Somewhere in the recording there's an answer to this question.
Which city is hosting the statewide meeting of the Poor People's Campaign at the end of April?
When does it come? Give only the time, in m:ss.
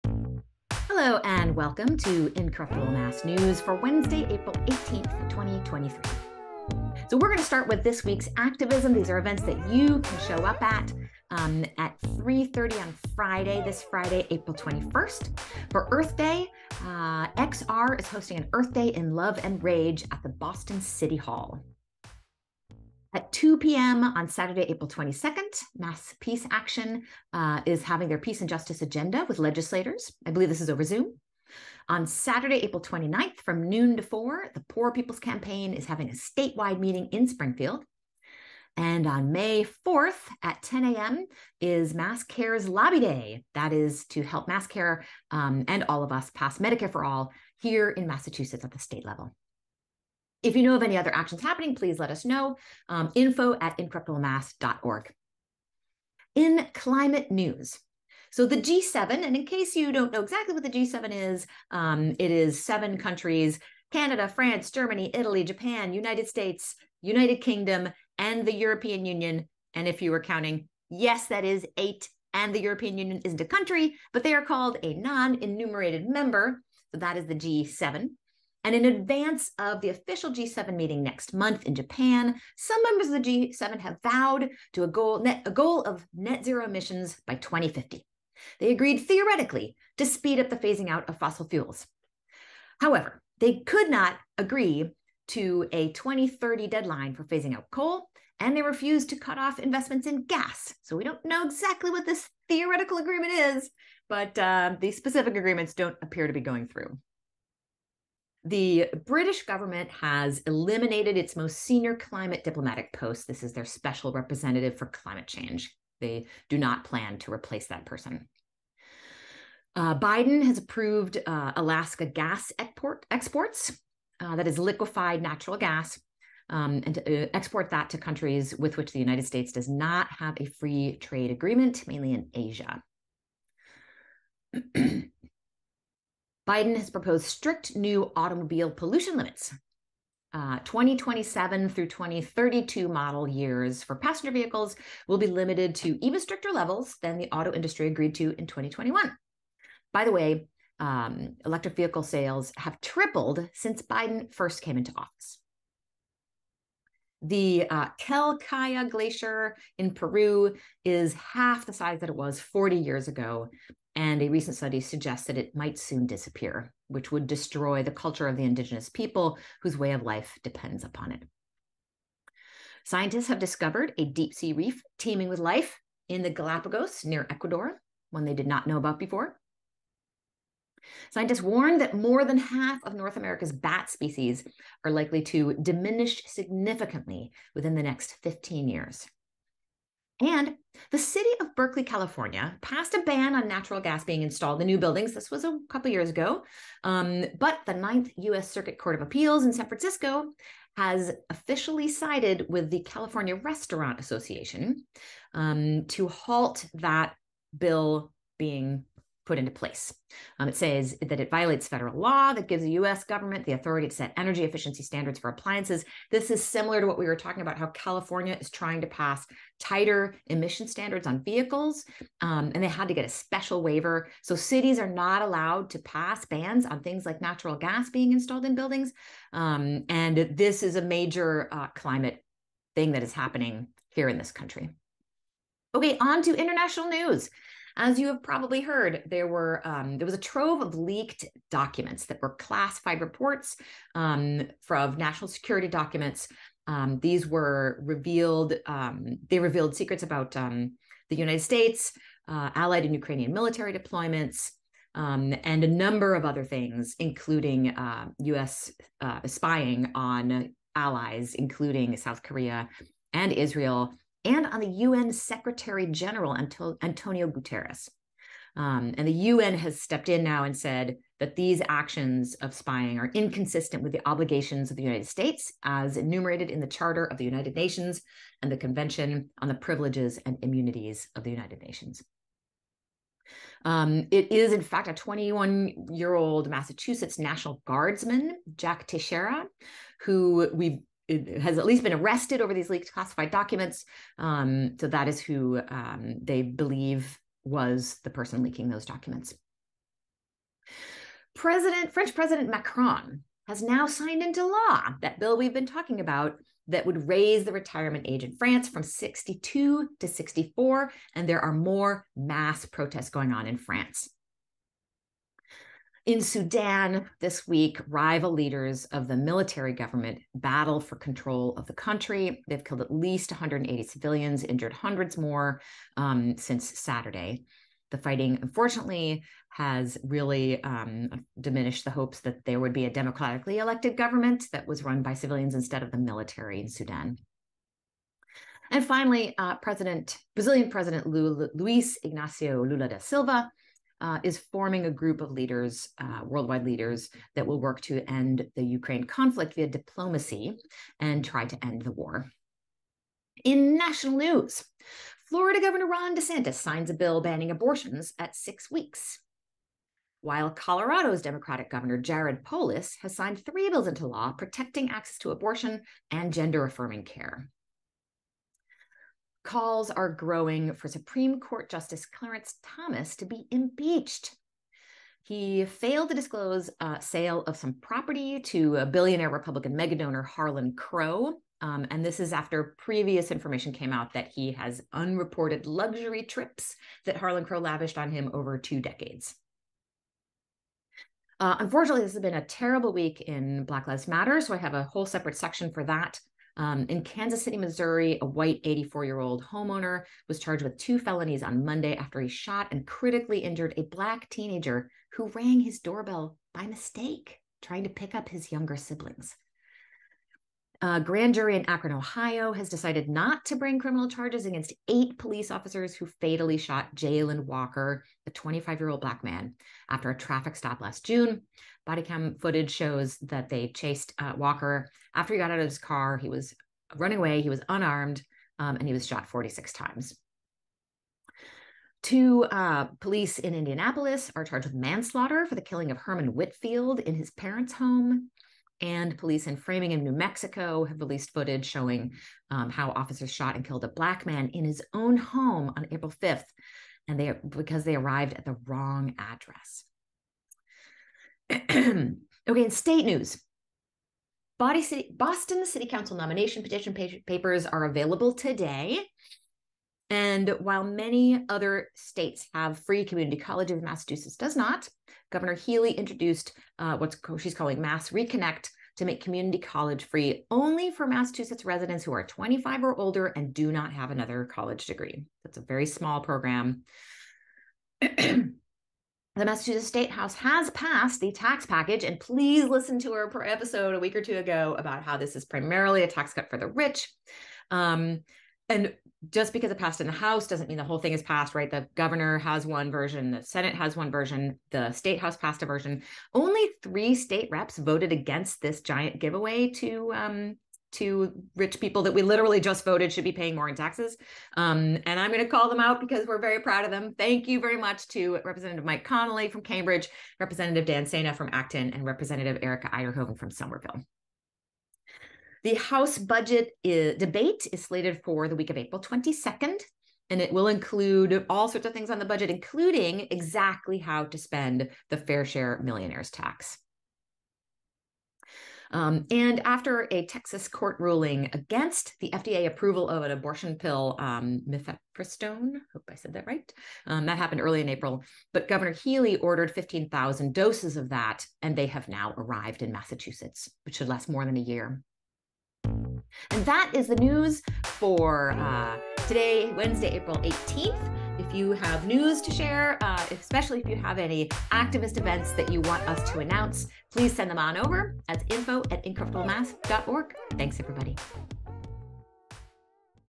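0:37.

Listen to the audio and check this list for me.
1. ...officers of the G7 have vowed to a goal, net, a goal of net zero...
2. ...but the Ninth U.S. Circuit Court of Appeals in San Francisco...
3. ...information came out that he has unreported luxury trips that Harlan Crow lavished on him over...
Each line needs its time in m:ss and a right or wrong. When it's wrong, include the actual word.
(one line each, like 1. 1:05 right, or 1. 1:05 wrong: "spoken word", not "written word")
1. 1:22 wrong: "members", not "officers"
2. 3:17 right
3. 6:23 right.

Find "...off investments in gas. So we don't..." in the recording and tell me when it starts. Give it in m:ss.
1:39.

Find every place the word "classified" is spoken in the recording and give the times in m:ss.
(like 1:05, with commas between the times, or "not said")
4:02, 4:52.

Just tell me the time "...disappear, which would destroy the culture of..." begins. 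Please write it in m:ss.
2:46.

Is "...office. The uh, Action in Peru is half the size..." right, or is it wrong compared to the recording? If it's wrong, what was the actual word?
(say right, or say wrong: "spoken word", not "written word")
wrong: "Glacier", not "Action".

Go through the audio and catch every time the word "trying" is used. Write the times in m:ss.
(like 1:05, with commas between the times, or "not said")
3:38, 6:47.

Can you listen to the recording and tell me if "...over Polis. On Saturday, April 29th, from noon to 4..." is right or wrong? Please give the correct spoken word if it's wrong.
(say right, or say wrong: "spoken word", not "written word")
wrong: "Zoom", not "Polis".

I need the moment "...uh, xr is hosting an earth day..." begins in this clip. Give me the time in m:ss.
0:16.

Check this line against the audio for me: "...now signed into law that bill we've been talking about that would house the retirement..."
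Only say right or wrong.
wrong.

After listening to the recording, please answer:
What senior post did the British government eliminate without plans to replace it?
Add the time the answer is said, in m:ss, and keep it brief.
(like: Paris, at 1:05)
special representative for climate change, at 1:53.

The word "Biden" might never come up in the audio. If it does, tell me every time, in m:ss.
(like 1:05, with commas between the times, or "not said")
1:59, 2:16, 2:33.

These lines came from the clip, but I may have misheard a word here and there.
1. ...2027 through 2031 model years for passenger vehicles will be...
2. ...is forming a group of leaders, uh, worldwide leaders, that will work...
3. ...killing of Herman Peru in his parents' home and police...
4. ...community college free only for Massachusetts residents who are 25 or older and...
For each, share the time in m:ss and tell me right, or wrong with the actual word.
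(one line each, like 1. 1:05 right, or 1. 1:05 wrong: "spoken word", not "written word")
1. 2:20 wrong: "2032", not "2031"
2. 5:44 right
3. 7:15 wrong: "Whitfield", not "Peru"
4. 7:49 right.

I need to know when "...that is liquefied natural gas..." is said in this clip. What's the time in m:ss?
2:04.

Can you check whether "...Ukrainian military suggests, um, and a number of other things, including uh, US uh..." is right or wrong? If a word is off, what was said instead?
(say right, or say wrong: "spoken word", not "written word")
wrong: "deployments", not "suggests".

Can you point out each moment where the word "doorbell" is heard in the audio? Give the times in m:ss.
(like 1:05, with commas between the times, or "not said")
6:45.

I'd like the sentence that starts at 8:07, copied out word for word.
Um, and just because it passed in the House doesn't mean the whole thing is passed, right?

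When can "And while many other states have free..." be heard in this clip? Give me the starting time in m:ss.
7:40.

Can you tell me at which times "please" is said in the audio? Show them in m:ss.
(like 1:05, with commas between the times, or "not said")
0:51, 8:02, 9:17.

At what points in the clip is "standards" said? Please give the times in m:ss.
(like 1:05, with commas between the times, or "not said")
3:34, 3:40.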